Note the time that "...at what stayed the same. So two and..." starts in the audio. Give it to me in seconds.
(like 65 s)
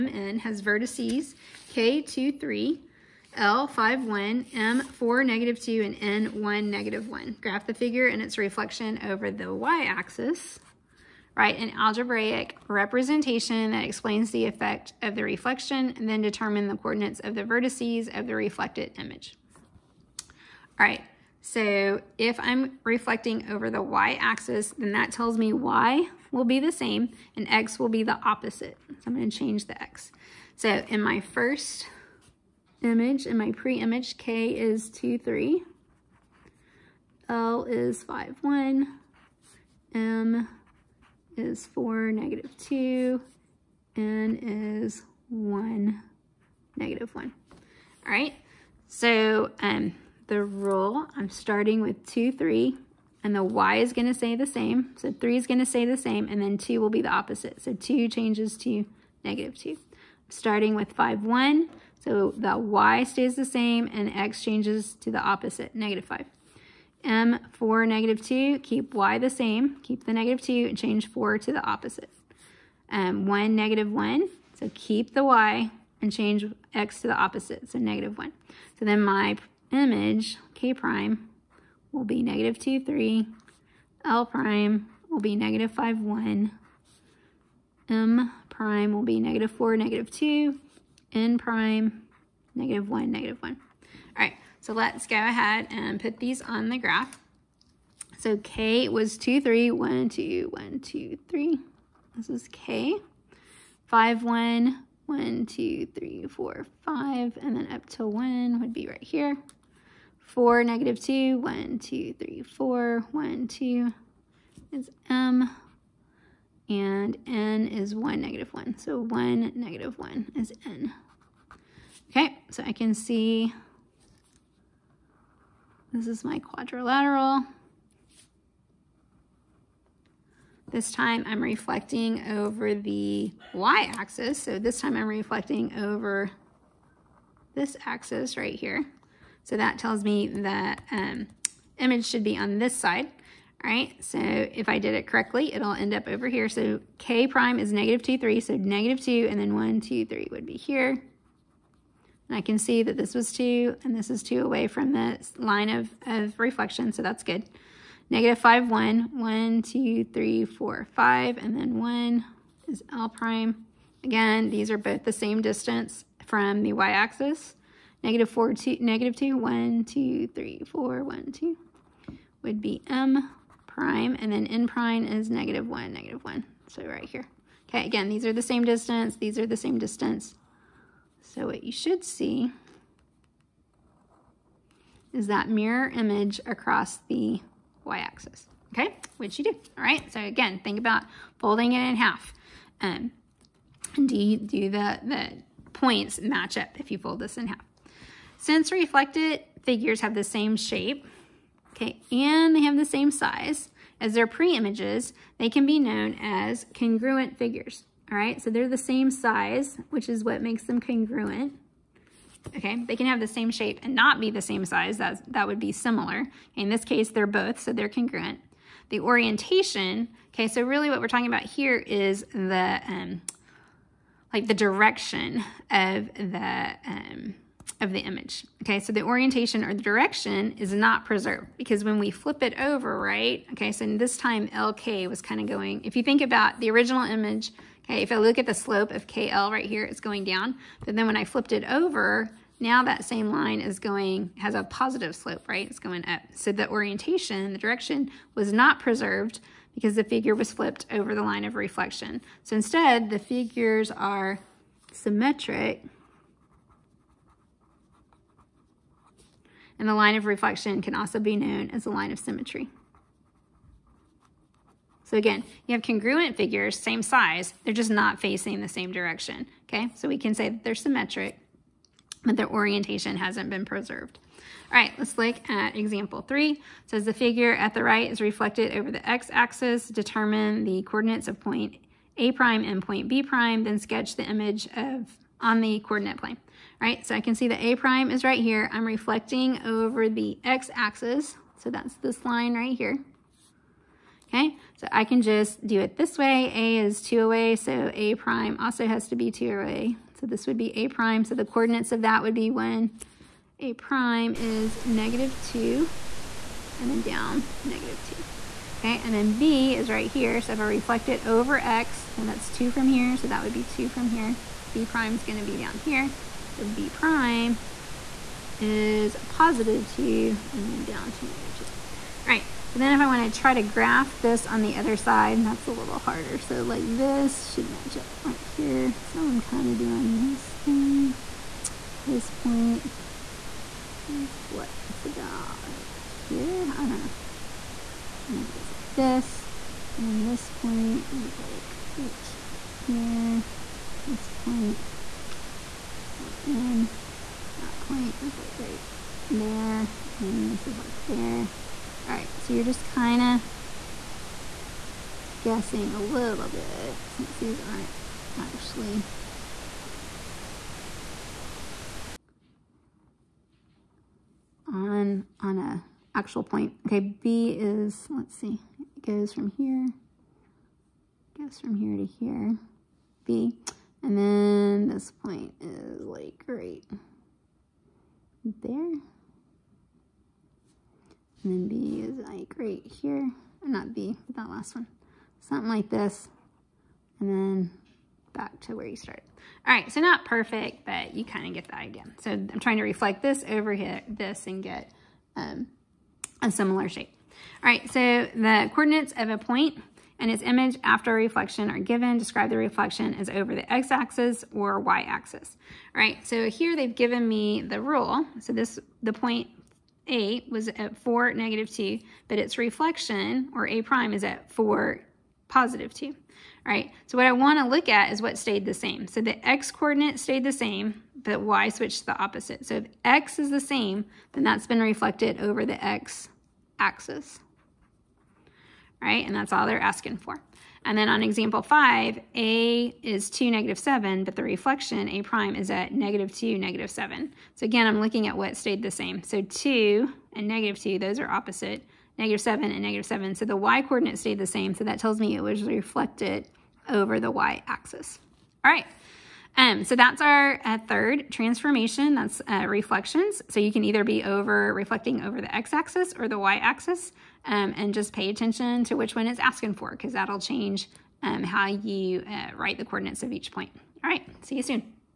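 438 s.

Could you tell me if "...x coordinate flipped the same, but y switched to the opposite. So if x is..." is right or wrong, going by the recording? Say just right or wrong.
wrong.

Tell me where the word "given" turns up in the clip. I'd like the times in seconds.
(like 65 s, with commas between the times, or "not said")
401 s, 406 s.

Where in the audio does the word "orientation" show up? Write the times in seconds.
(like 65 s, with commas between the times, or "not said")
218 s, 229 s, 246 s, 272 s.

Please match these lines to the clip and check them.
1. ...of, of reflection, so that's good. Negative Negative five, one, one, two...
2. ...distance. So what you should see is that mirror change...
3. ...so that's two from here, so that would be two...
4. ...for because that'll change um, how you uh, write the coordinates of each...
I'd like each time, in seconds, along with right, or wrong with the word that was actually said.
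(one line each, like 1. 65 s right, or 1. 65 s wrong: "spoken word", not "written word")
1. 155 s right
2. 179 s wrong: "image", not "change"
3. 312 s right
4. 459 s right.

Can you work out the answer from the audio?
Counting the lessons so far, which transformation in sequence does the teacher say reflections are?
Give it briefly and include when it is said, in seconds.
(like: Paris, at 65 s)
third, at 450 s.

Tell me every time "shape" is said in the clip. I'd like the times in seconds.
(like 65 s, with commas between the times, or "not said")
200 s, 213 s, 396 s.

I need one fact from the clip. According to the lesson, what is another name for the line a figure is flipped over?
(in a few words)
line of symmetry.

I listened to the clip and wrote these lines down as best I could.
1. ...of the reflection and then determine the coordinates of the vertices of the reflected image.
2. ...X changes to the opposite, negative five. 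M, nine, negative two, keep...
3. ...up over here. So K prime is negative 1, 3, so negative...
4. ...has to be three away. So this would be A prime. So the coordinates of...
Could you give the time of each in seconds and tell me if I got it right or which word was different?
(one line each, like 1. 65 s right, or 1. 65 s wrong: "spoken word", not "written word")
1. 15 s right
2. 64 s wrong: "four", not "nine"
3. 145 s wrong: "2", not "1"
4. 298 s wrong: "two", not "three".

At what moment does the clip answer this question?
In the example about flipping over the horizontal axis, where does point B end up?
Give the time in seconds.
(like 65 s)
316 s.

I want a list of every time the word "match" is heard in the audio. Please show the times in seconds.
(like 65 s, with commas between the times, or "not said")
196 s, 327 s.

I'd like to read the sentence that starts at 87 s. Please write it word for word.
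M prime will be negative 4, negative 2.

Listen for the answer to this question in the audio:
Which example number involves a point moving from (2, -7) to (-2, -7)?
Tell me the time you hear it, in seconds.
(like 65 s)
431 s.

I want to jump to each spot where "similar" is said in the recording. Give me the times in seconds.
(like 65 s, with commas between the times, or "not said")
215 s, 396 s.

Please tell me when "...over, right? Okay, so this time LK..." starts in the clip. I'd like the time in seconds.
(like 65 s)
232 s.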